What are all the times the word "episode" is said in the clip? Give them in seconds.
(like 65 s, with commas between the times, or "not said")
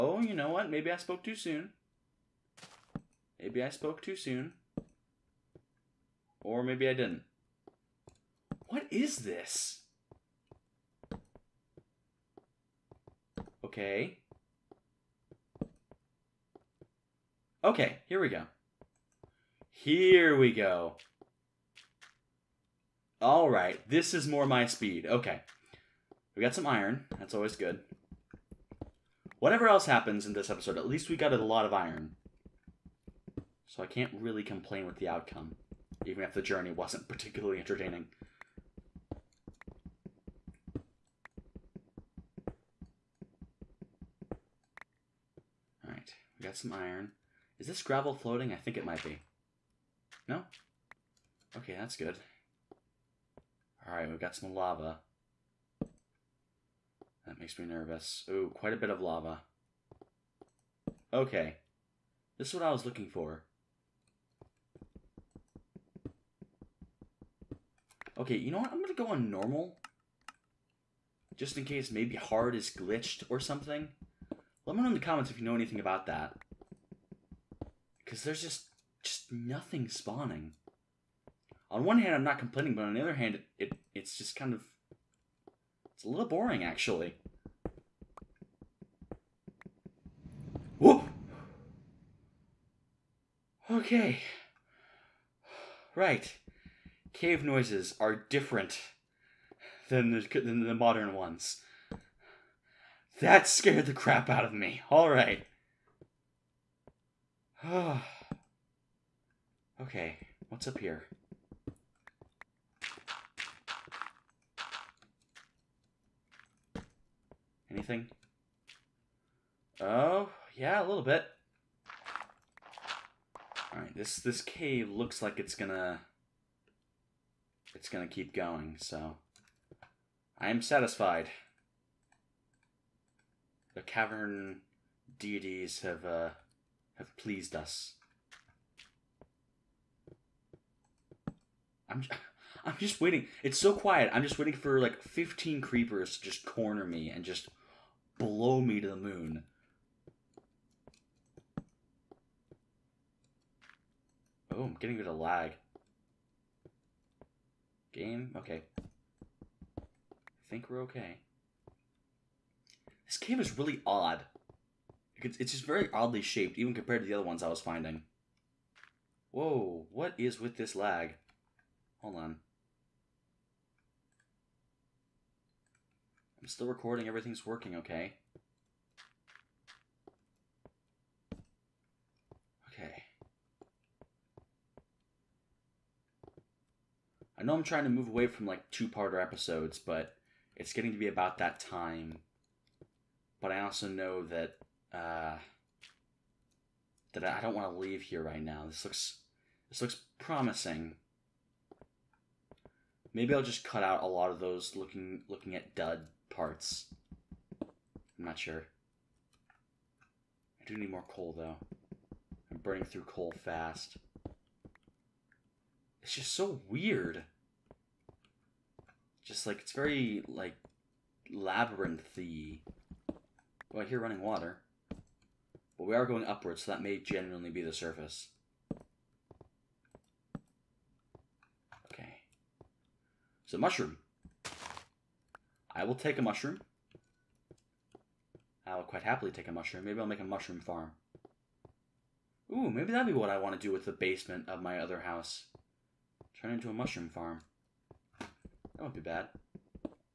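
30 s, 189 s.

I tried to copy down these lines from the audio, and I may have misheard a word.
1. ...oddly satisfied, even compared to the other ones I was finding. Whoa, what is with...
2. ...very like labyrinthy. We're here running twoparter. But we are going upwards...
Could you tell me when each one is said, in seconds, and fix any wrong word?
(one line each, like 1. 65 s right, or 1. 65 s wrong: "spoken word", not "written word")
1. 165 s wrong: "shaped", not "satisfied"
2. 219 s wrong: "water", not "twoparter".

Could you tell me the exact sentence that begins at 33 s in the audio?
So I can't really complain with the outcome, even if the journey wasn't particularly entertaining.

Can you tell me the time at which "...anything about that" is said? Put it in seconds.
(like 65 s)
75 s.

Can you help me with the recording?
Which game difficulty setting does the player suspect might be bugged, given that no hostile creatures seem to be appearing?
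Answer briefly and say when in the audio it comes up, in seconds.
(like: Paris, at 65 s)
Hard, at 72 s.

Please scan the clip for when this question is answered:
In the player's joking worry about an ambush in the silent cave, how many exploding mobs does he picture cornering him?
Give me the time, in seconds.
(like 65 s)
145 s.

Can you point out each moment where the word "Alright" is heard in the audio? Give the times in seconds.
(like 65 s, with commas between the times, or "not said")
53 s, 123 s.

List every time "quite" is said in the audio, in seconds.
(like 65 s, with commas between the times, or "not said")
58 s, 238 s.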